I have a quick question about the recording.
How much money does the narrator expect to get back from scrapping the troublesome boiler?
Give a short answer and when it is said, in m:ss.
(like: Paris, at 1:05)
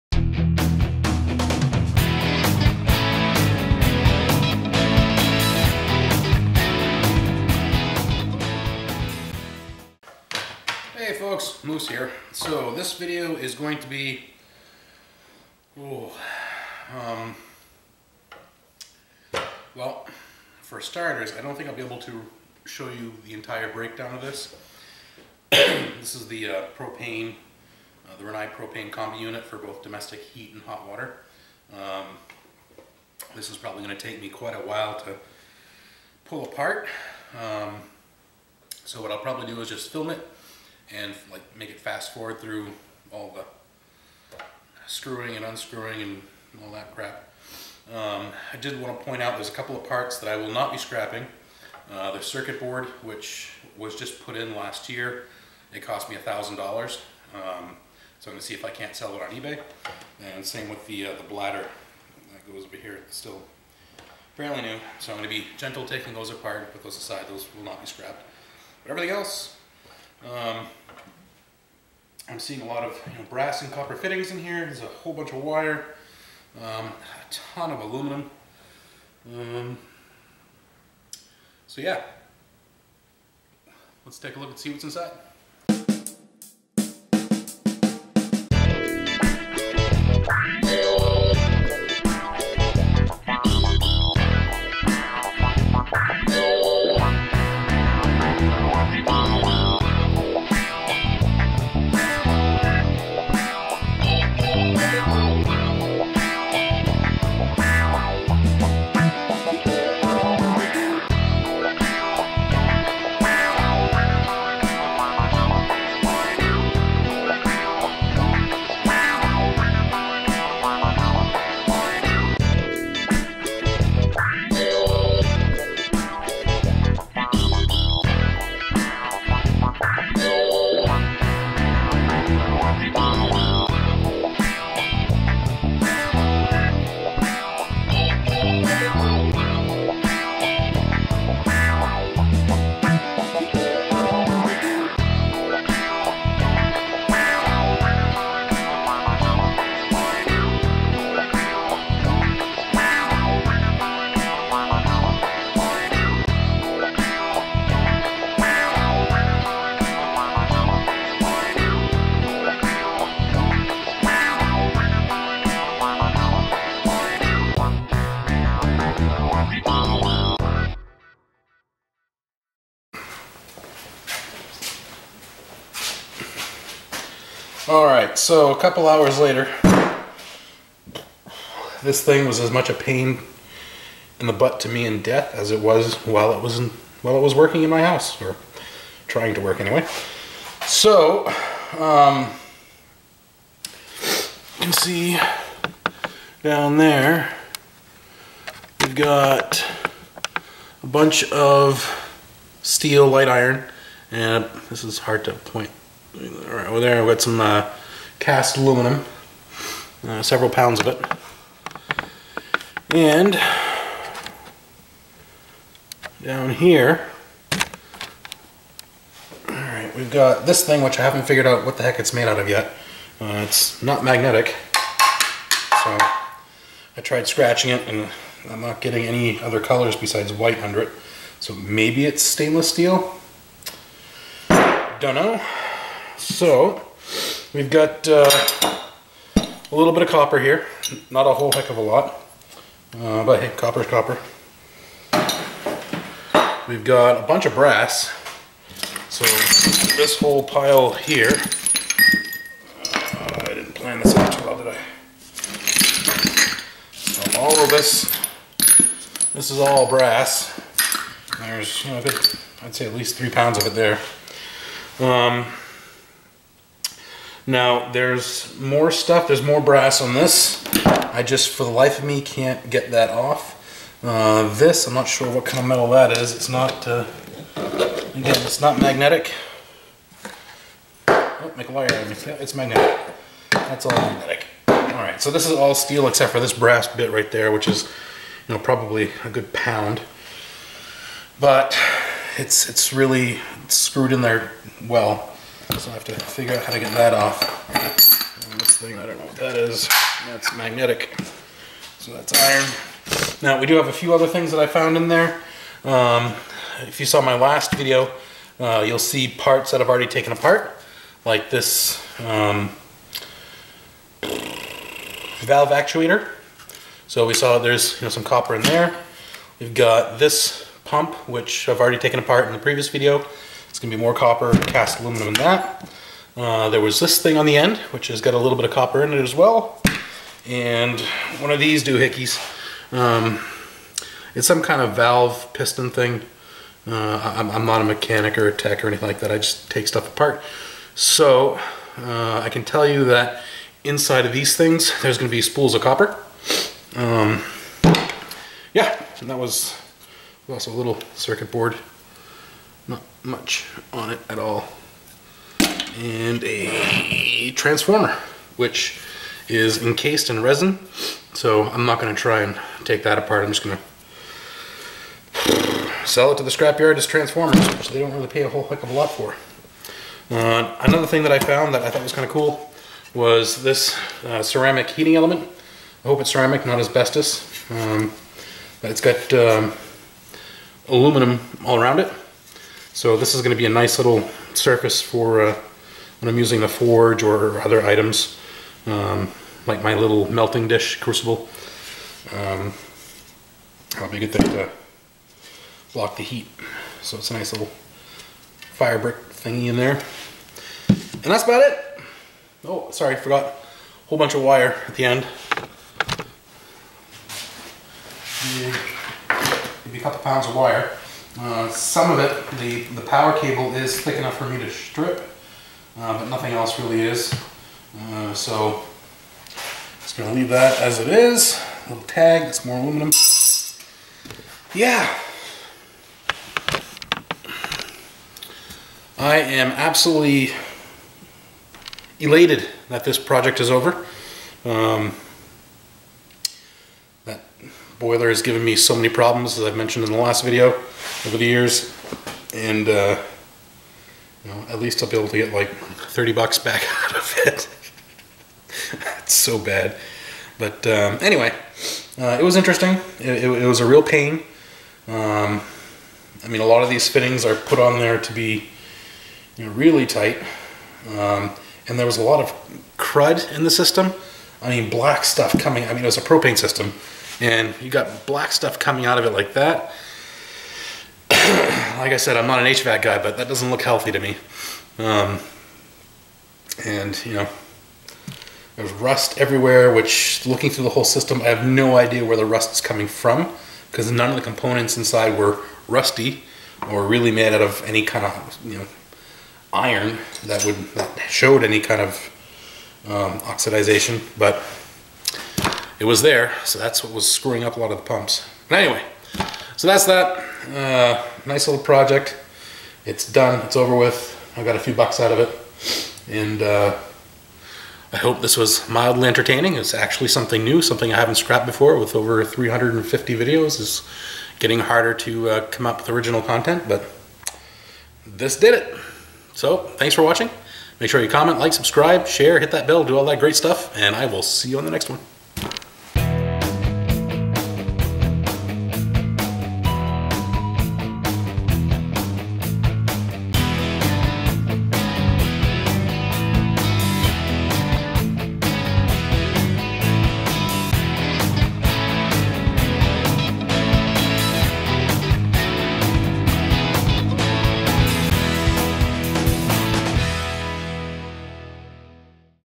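$30, at 7:25.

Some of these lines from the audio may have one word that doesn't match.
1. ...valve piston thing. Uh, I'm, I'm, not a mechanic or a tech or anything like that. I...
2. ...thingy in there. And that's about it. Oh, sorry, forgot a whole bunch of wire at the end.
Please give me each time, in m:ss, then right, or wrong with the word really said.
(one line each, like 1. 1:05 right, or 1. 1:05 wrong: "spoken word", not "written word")
1. 5:34 right
2. 6:39 right.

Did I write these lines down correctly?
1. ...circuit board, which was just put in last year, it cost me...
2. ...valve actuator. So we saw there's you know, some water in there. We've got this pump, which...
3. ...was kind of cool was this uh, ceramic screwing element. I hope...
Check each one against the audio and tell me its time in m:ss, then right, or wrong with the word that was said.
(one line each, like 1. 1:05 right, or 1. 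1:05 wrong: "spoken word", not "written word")
1. 0:52 right
2. 5:14 wrong: "copper", not "water"
3. 6:12 wrong: "heating", not "screwing".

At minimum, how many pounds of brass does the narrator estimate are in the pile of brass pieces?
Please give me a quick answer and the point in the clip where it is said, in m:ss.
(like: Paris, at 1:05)
3 pounds, at 4:23.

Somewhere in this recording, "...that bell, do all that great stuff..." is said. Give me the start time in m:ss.
8:42.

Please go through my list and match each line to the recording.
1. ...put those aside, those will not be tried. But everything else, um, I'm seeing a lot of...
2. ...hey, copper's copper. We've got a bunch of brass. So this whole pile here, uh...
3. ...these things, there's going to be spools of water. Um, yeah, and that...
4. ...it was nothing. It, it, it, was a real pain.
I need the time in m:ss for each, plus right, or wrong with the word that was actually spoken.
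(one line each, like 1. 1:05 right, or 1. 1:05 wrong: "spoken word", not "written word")
1. 1:06 wrong: "scrapped", not "tried"
2. 4:03 right
3. 5:44 wrong: "copper", not "water"
4. 7:32 wrong: "interesting", not "nothing".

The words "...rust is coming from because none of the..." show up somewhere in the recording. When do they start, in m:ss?
8:02.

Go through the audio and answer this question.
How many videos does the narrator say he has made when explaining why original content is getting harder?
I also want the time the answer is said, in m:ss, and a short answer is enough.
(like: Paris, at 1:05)
Over 350, at 8:32.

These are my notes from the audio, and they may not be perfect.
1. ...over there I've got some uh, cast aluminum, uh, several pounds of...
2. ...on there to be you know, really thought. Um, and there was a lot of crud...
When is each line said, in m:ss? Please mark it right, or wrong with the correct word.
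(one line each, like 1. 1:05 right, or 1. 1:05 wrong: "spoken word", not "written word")
1. 3:26 right
2. 7:37 wrong: "tight", not "thought".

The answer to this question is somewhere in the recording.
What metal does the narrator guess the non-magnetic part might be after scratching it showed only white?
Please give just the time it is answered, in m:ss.
3:52.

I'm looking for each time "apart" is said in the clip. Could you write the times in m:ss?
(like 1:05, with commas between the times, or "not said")
0:36, 1:06, 5:10, 5:22, 5:40, 6:03.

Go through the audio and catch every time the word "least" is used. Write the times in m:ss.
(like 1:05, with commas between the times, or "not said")
4:22, 7:24.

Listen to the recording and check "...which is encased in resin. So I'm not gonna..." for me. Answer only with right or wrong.
right.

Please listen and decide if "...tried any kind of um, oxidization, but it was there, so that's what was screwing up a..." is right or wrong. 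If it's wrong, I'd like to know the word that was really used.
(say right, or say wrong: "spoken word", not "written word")
wrong: "showed", not "tried".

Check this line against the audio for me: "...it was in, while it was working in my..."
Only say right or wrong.
right.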